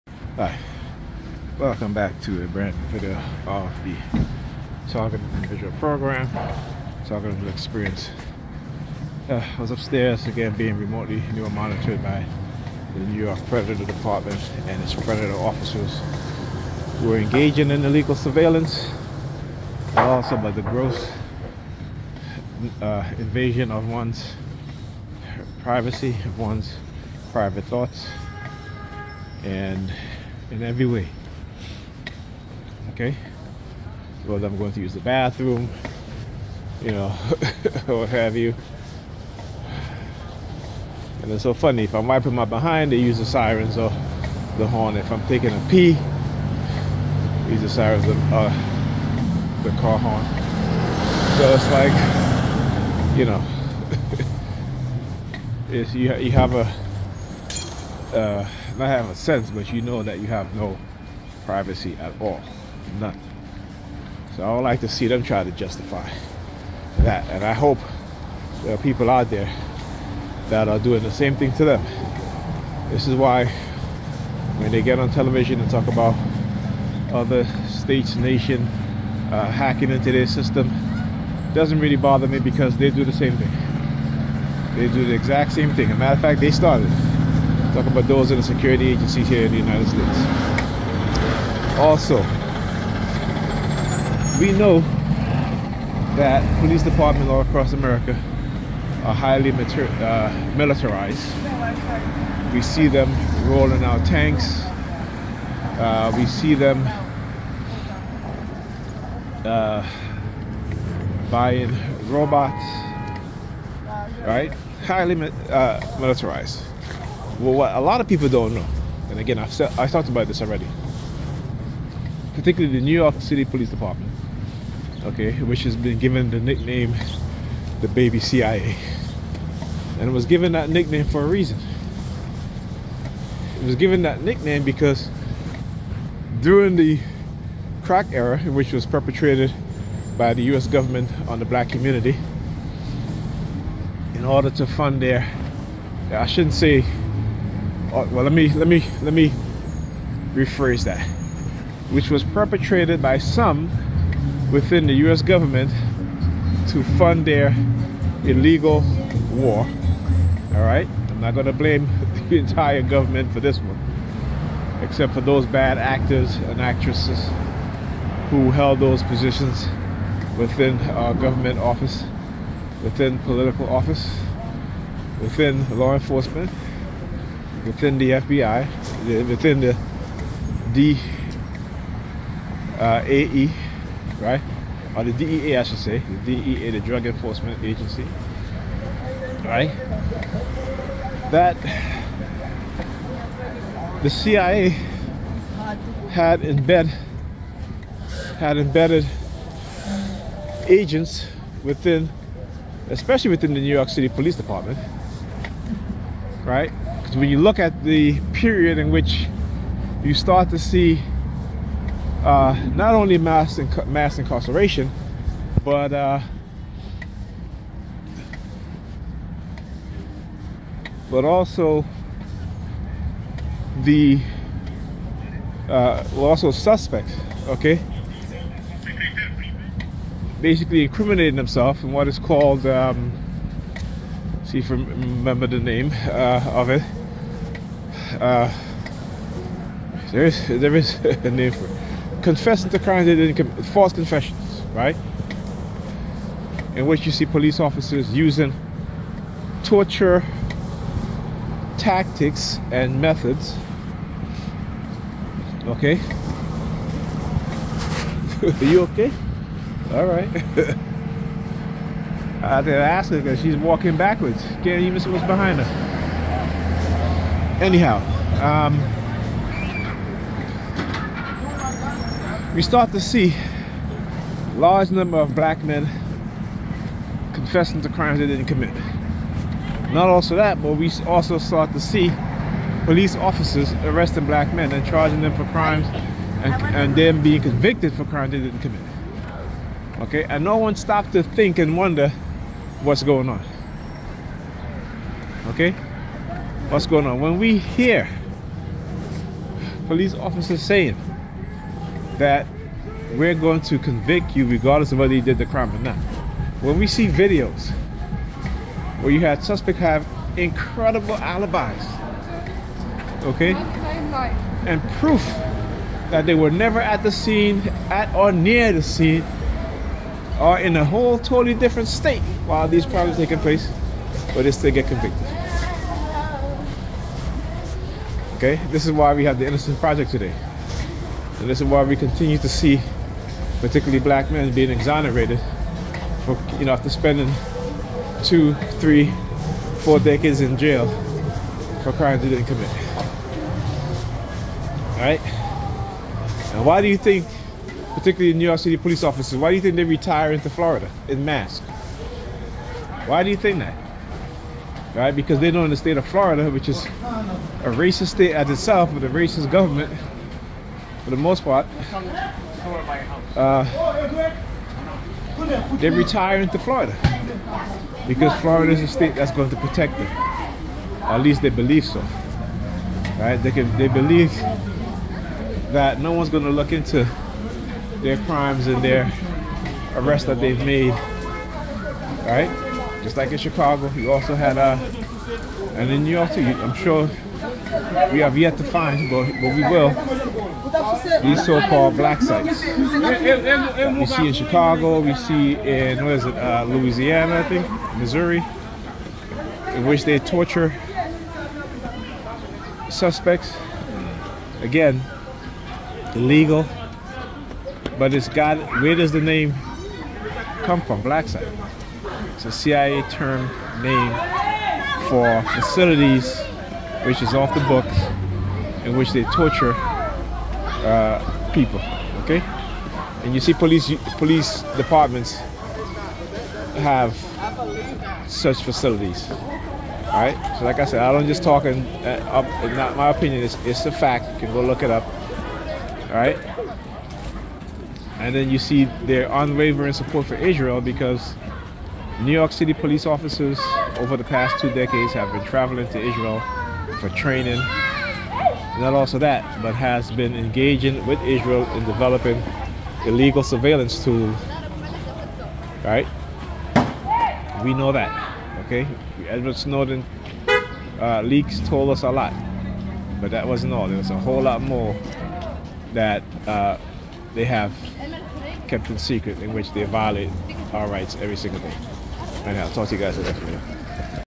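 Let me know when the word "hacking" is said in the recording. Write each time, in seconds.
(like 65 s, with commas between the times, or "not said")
79 s.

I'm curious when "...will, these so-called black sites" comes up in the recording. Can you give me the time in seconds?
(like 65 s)
389 s.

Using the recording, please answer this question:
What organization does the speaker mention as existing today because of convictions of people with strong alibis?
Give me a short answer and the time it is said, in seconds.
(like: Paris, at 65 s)
Innocent Project, at 329 s.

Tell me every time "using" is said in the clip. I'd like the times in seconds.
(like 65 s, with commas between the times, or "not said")
248 s.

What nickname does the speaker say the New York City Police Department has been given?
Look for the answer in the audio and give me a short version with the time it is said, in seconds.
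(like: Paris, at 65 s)
the baby CIA, at 127 s.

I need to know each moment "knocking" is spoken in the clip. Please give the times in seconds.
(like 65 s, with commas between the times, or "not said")
not said.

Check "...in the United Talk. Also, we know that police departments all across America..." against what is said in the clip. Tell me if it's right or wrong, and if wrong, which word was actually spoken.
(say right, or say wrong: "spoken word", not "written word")
wrong: "States", not "Talk".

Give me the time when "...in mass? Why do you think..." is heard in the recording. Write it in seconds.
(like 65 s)
351 s.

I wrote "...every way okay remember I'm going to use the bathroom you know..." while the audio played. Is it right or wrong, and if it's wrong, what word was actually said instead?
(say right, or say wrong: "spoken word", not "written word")
wrong: "whether", not "remember".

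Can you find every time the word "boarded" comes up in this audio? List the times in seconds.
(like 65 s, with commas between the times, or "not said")
not said.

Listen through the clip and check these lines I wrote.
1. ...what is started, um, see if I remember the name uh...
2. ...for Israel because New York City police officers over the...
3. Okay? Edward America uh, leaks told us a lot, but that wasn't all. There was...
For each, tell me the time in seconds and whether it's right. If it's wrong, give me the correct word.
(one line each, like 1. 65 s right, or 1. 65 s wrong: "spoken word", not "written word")
1. 231 s wrong: "called", not "started"
2. 440 s right
3. 458 s wrong: "Snowden", not "America".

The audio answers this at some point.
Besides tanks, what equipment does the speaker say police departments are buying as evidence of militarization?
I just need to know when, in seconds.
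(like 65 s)
112 s.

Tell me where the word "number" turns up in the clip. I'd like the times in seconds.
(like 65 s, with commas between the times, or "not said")
274 s.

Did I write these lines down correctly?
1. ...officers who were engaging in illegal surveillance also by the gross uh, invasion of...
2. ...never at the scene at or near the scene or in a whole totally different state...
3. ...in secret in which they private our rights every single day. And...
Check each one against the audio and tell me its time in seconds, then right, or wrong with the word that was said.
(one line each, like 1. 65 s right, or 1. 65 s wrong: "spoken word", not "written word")
1. 15 s right
2. 316 s right
3. 468 s wrong: "violate", not "private".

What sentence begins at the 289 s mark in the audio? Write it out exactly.
Okay, and no one stopped to think and wonder what's going on.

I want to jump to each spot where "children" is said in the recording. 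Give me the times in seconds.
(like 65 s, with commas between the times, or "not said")
not said.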